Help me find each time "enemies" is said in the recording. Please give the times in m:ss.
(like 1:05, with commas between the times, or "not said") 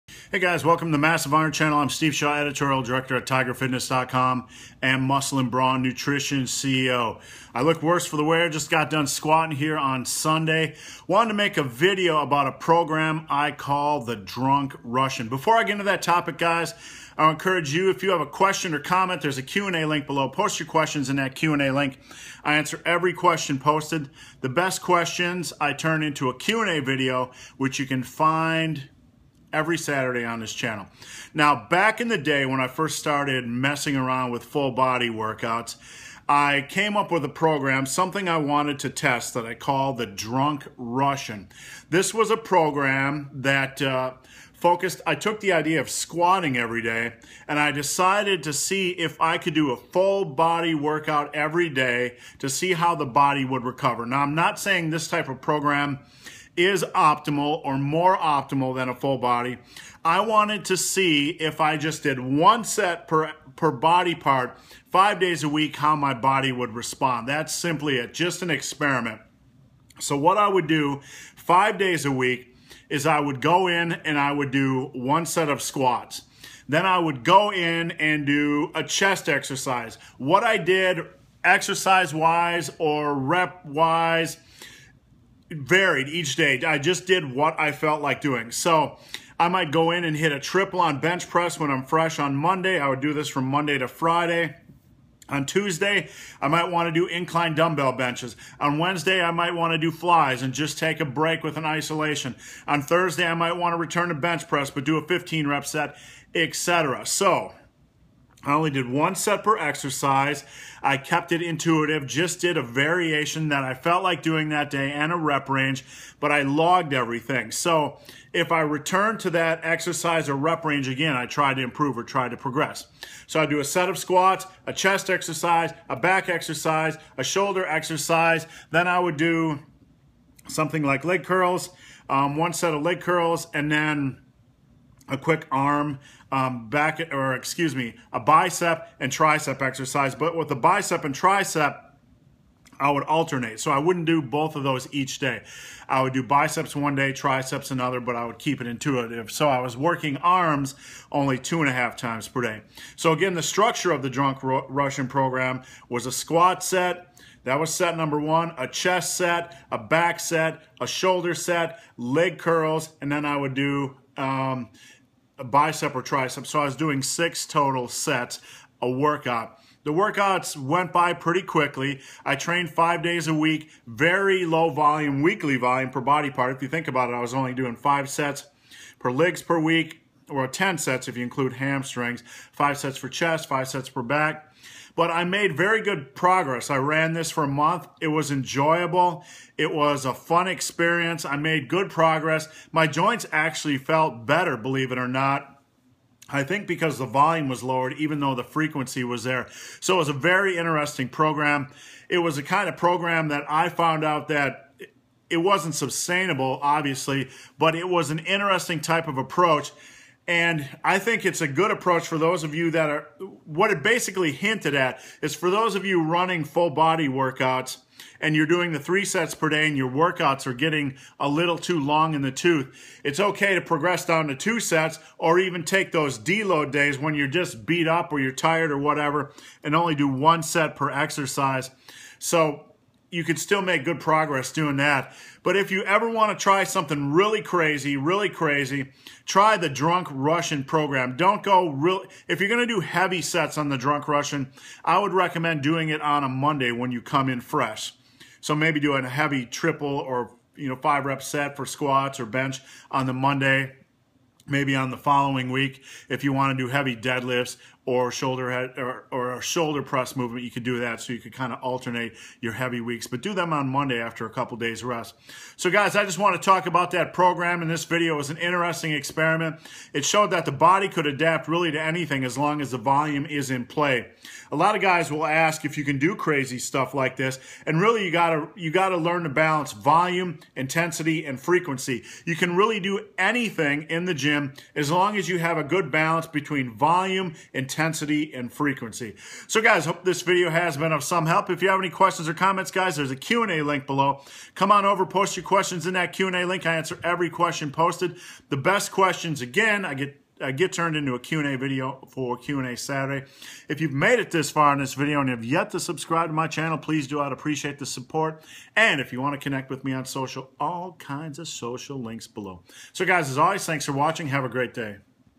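not said.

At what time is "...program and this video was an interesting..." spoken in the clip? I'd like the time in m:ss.
4:27.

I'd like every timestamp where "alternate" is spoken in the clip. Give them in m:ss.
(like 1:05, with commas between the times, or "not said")
2:23, 4:21.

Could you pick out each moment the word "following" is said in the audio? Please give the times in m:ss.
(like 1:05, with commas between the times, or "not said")
4:14.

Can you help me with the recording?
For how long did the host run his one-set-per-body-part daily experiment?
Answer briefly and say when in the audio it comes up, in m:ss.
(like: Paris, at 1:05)
a month, at 3:07.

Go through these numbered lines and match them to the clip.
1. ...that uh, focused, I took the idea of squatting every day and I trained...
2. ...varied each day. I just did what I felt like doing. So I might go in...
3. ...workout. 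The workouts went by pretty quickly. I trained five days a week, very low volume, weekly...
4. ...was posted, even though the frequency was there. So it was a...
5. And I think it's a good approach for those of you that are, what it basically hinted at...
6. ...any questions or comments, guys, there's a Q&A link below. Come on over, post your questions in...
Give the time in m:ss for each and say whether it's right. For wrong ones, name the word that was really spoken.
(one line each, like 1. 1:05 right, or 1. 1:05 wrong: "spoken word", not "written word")
1. 0:43 wrong: "decided", not "trained"
2. 1:25 right
3. 2:48 right
4. 3:17 wrong: "lowered", not "posted"
5. 3:30 right
6. 4:51 right.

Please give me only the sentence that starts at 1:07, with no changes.
That's simply it, just an experiment.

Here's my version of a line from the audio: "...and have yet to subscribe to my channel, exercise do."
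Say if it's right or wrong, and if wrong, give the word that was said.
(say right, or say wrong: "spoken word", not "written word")
wrong: "please", not "exercise".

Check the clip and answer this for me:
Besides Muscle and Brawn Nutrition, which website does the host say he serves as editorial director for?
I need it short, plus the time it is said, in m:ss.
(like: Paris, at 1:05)
TigerFitness.com, at 0:03.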